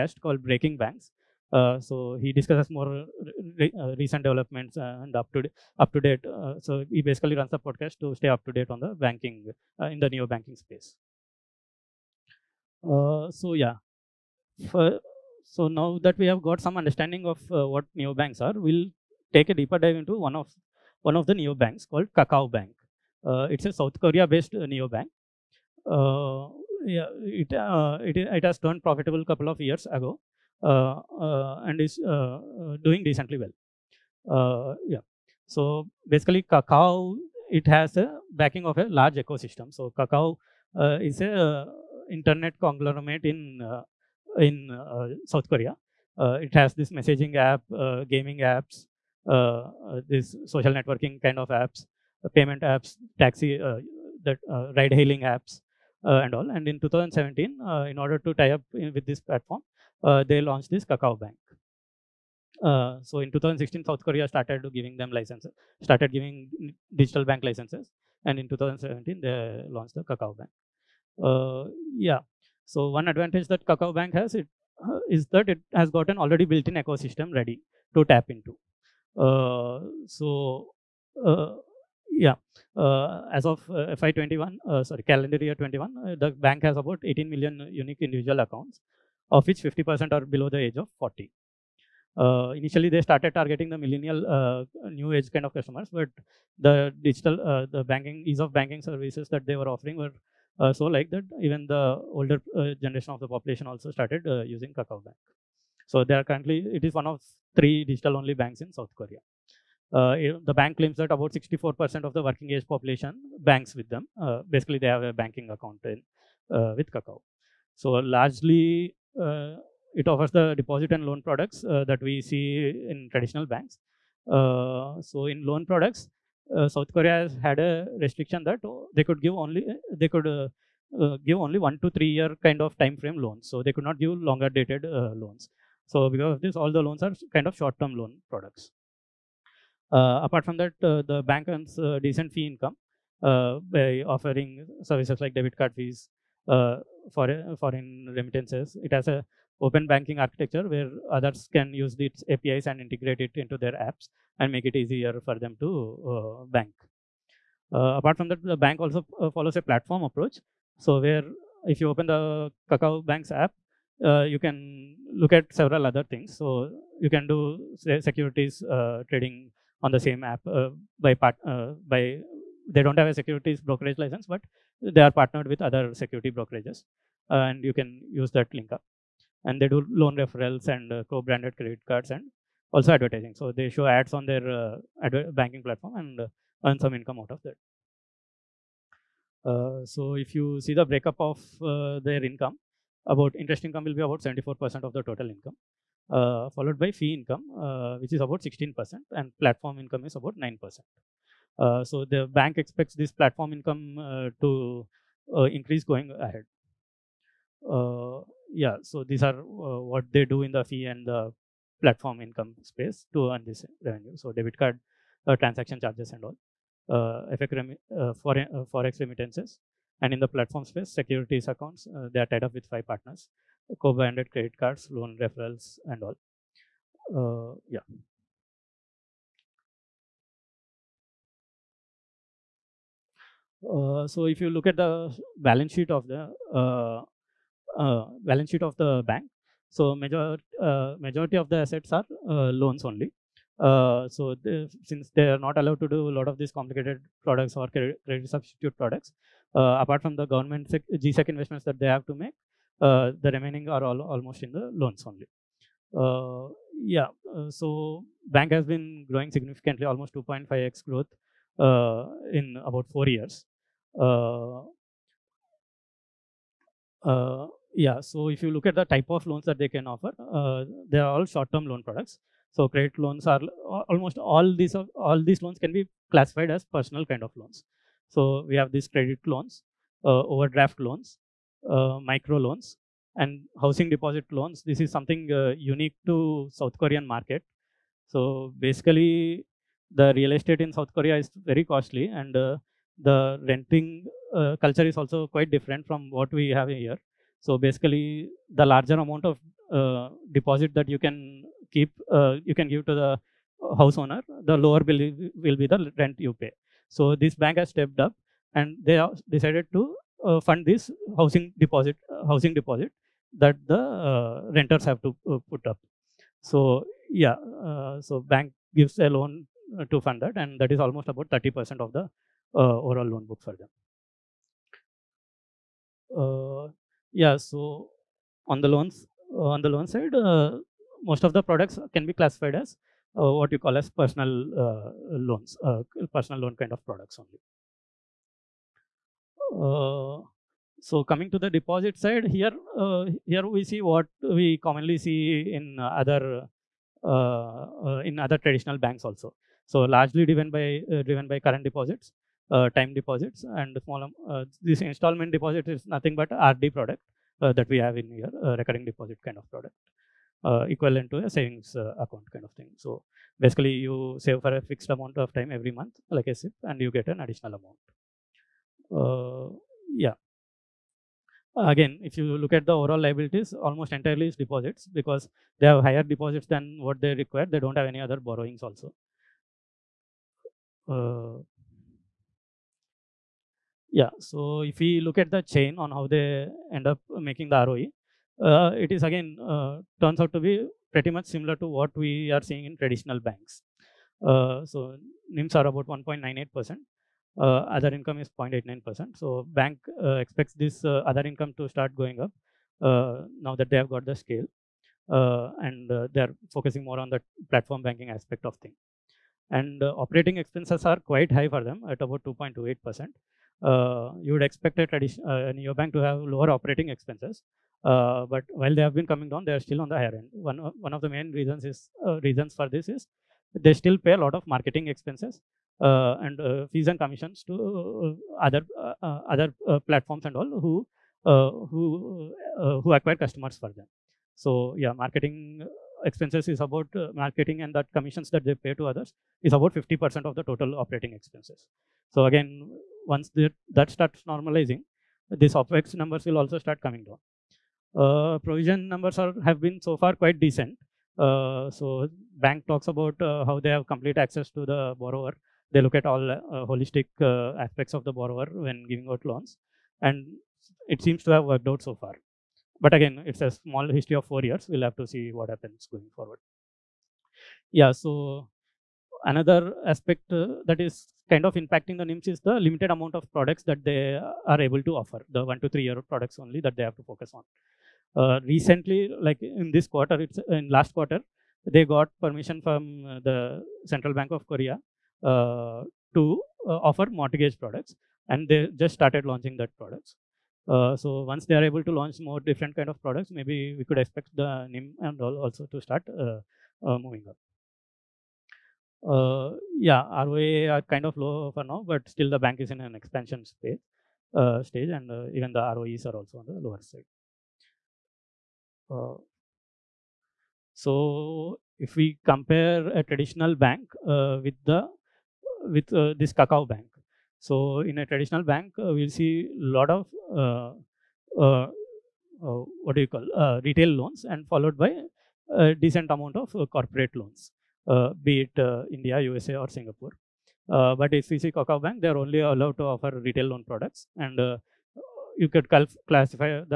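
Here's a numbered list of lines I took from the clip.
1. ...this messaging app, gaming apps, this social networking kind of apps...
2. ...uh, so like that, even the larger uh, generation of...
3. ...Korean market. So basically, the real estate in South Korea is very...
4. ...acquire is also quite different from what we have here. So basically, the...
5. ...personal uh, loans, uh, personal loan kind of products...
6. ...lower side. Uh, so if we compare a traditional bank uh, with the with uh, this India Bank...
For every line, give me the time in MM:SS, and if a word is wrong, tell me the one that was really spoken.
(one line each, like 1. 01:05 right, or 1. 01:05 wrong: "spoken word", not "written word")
1. 00:46 right
2. 01:40 wrong: "older", not "larger"
3. 04:46 right
4. 04:54 wrong: "culture", not "acquire"
5. 05:34 right
6. 08:26 wrong: "Kakao", not "India".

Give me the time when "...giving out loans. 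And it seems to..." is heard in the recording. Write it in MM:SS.
07:38.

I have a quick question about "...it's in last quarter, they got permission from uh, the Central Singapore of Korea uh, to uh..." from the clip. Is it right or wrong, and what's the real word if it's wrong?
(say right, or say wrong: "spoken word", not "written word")
wrong: "Bank", not "Singapore".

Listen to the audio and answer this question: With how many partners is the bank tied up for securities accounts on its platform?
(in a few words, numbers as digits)
five.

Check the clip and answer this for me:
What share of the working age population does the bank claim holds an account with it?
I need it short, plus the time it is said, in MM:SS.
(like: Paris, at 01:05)
64%, at 01:51.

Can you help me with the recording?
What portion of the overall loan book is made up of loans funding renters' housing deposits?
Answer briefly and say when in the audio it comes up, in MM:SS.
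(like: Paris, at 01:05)
30%, at 05:21.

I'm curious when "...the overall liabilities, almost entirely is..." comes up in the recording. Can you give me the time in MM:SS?
06:12.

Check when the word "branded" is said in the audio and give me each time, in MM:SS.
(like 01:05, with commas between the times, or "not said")
03:01, 03:43.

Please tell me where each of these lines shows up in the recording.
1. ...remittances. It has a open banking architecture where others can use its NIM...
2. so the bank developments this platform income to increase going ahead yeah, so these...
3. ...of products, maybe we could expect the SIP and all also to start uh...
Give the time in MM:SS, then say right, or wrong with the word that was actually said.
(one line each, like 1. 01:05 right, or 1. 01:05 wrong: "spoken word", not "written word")
1. 02:28 wrong: "APIs", not "NIM"
2. 03:21 wrong: "expects", not "developments"
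3. 08:12 wrong: "NIM", not "SIP".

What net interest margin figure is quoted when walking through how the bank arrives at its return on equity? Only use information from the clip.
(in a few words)
1.98%.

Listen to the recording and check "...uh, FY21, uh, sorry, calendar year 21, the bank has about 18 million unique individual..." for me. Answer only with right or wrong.
right.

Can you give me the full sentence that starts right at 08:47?
Uh, be it uh, India, USA, or Singapore.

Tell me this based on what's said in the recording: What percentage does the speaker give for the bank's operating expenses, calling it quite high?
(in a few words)
2.28%.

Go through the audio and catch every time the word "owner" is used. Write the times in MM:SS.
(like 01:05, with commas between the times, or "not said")
05:04.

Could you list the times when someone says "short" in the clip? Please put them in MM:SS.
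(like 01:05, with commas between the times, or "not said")
02:17, 04:31.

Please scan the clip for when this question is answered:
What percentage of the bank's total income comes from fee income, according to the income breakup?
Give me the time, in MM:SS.
03:18.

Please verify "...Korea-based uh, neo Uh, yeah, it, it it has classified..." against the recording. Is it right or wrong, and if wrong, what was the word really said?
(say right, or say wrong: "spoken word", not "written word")
wrong: "turned", not "classified".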